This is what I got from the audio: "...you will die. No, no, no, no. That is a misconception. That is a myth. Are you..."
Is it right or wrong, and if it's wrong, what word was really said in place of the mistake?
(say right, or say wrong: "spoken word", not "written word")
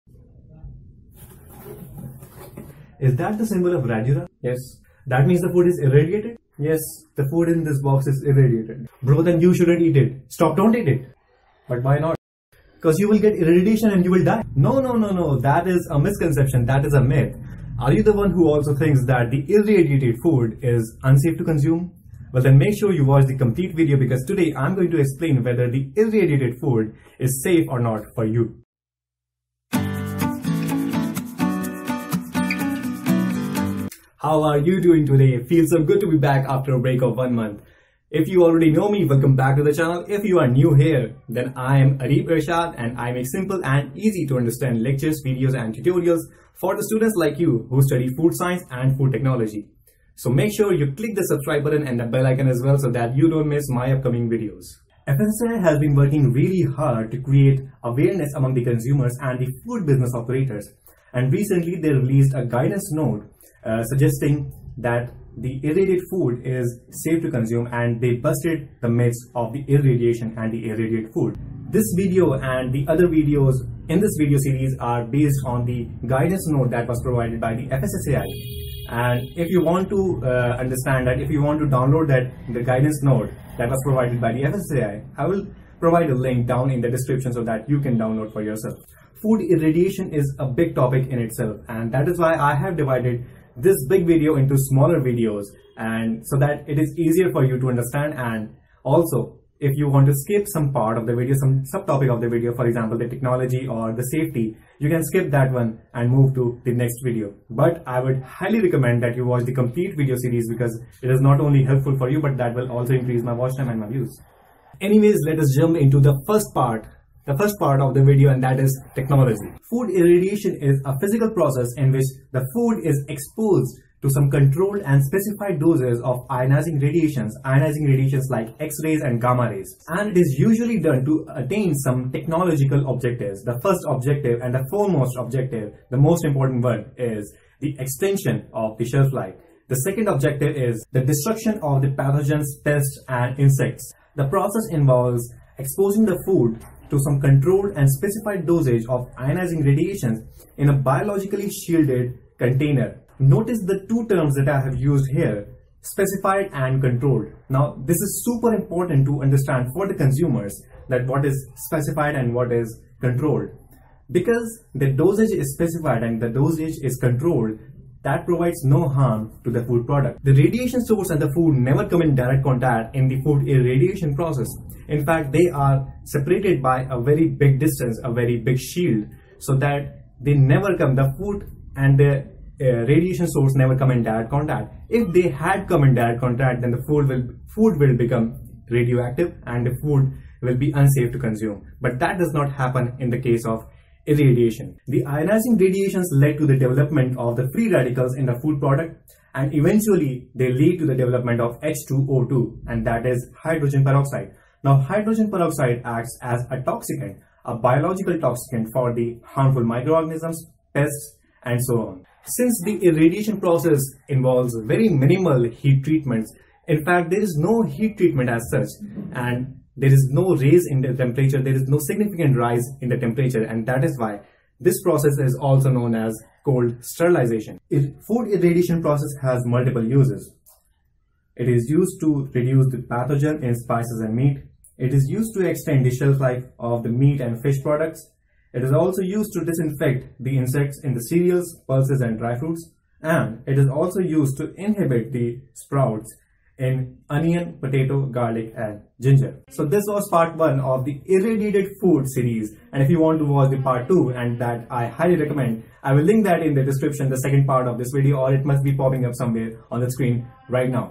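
right.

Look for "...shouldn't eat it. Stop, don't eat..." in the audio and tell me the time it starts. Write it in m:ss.
0:09.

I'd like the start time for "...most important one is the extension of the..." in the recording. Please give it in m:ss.
2:15.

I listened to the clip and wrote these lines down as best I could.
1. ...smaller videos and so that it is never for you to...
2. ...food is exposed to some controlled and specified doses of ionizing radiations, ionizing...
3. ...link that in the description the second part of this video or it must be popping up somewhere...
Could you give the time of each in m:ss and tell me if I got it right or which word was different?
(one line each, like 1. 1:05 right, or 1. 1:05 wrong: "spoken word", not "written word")
1. 1:34 wrong: "easier", not "never"
2. 2:02 right
3. 4:16 right.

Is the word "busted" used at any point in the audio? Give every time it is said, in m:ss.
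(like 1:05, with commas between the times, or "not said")
1:08.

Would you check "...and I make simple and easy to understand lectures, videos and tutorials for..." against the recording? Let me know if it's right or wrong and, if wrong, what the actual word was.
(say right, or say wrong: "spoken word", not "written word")
right.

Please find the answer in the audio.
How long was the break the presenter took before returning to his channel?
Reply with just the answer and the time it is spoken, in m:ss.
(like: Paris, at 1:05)
One month, at 0:37.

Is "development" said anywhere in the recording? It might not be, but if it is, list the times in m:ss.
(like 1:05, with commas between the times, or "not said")
3:16, 3:20.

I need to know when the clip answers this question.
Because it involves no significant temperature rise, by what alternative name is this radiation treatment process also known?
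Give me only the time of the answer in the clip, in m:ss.
3:46.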